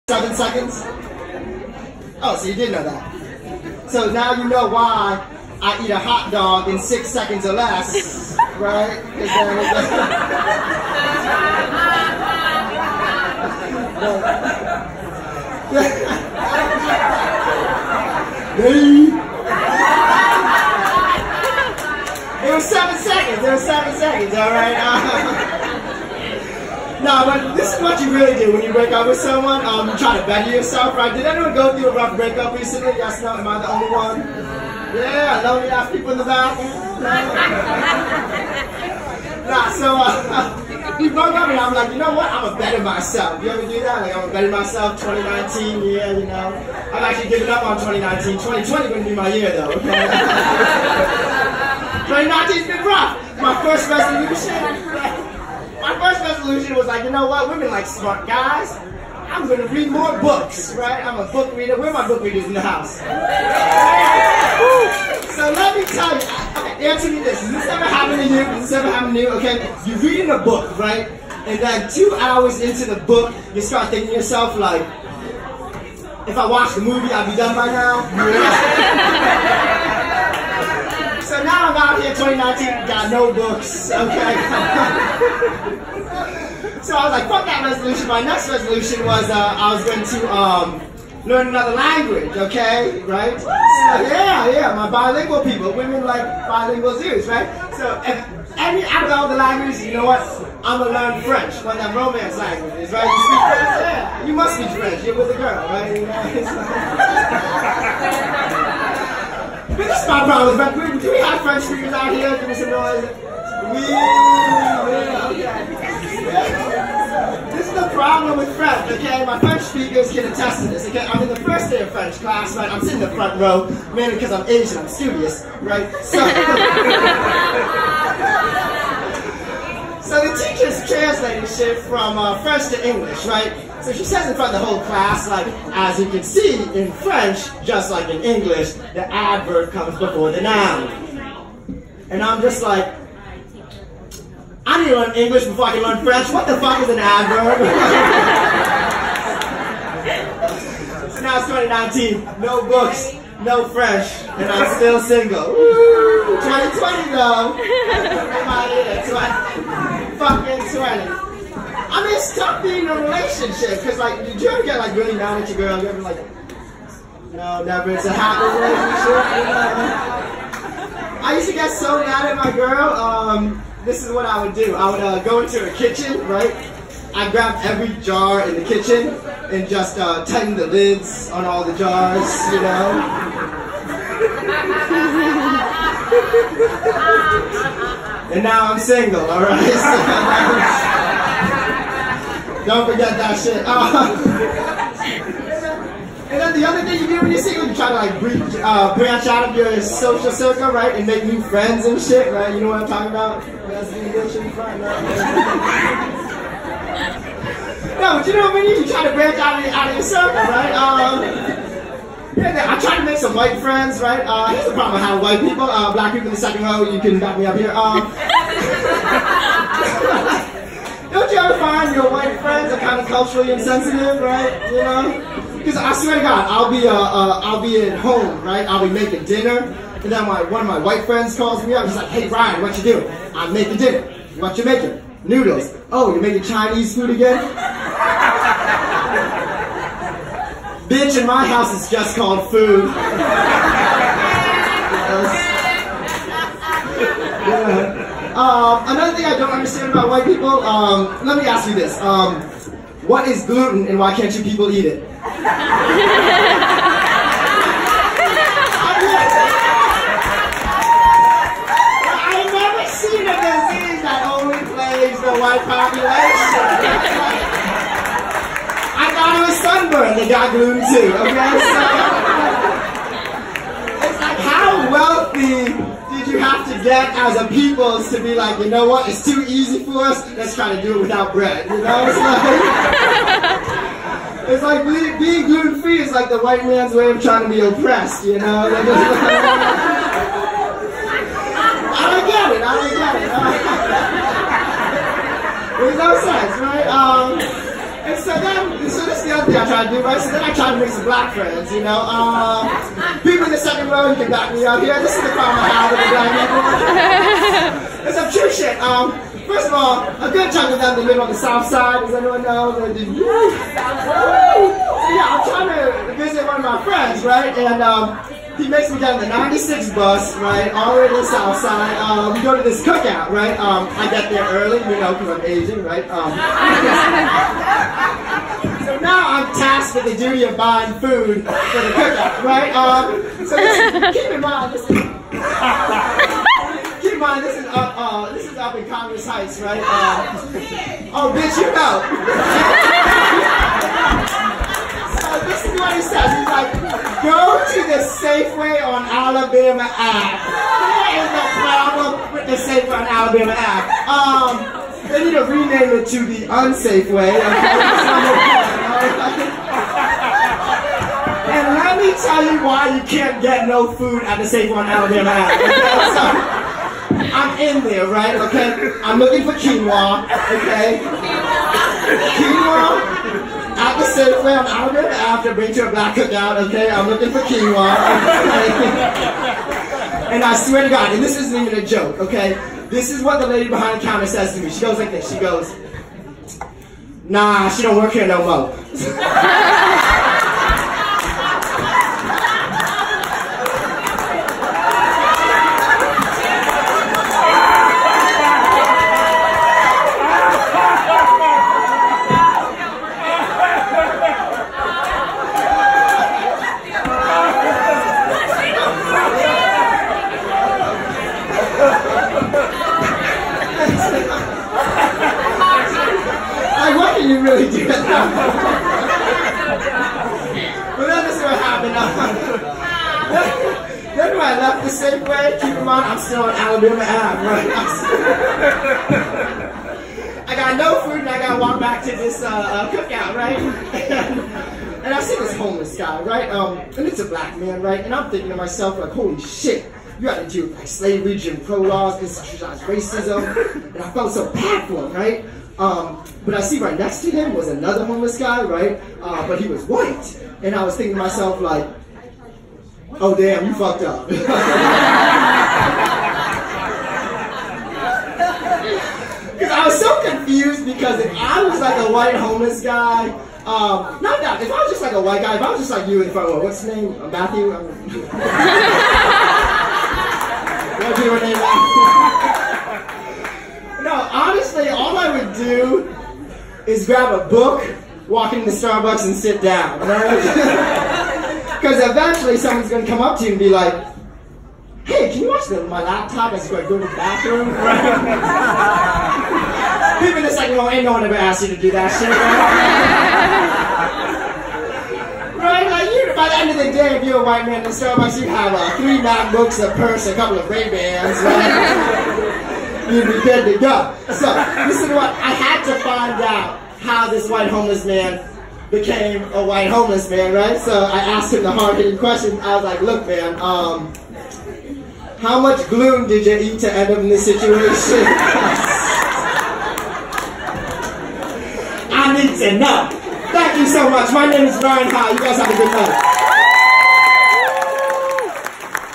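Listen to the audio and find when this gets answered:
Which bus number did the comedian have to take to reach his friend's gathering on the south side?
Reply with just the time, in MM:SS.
05:19.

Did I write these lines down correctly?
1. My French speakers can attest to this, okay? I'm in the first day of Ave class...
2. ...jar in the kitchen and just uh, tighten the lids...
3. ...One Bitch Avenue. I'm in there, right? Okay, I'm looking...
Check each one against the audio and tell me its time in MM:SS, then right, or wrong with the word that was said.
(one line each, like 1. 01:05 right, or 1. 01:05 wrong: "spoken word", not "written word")
1. 01:59 wrong: "French", not "Ave"
2. 02:58 right
3. 06:04 wrong: "Alabama", not "Bitch".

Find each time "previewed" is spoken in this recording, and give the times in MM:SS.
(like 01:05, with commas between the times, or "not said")
not said.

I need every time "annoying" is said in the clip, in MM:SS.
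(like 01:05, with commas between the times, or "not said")
not said.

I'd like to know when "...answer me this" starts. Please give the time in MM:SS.
01:06.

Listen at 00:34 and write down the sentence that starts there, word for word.
Yeah, lonely ass people in the back.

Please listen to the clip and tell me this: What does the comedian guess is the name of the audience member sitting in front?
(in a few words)
Matthew.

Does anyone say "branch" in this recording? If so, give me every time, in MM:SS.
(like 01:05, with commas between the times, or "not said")
03:18, 03:29.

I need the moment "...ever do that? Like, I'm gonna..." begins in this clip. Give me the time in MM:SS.
00:43.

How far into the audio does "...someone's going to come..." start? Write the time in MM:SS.
08:02.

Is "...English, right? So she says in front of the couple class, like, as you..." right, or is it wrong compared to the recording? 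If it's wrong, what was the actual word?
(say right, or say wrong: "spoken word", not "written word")
wrong: "whole", not "couple".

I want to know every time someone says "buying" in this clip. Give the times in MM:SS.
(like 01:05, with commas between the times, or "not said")
05:30.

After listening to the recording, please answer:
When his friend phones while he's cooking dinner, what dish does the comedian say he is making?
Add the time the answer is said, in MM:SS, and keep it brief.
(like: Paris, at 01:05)
Noodles, at 03:55.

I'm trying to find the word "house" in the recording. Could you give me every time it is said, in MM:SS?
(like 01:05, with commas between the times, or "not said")
01:02, 04:01.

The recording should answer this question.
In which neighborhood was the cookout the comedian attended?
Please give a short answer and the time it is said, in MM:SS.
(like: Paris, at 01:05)
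Congress Heights, at 05:38.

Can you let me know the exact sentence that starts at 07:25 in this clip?
Um, but I see right next to him was another homeless guy, right?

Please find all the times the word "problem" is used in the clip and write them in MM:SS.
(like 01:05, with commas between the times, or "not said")
01:50, 01:57, 03:34, 05:05, 05:51.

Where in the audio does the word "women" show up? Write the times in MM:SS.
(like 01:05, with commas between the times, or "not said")
00:57, 01:35.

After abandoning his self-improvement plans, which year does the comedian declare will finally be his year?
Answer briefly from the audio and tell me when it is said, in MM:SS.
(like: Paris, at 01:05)
2020, at 00:48.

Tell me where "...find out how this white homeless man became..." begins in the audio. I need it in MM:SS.
08:26.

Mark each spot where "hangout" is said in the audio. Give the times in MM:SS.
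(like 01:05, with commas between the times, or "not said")
not said.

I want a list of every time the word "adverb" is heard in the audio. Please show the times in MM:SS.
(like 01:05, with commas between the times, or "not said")
02:19, 02:26.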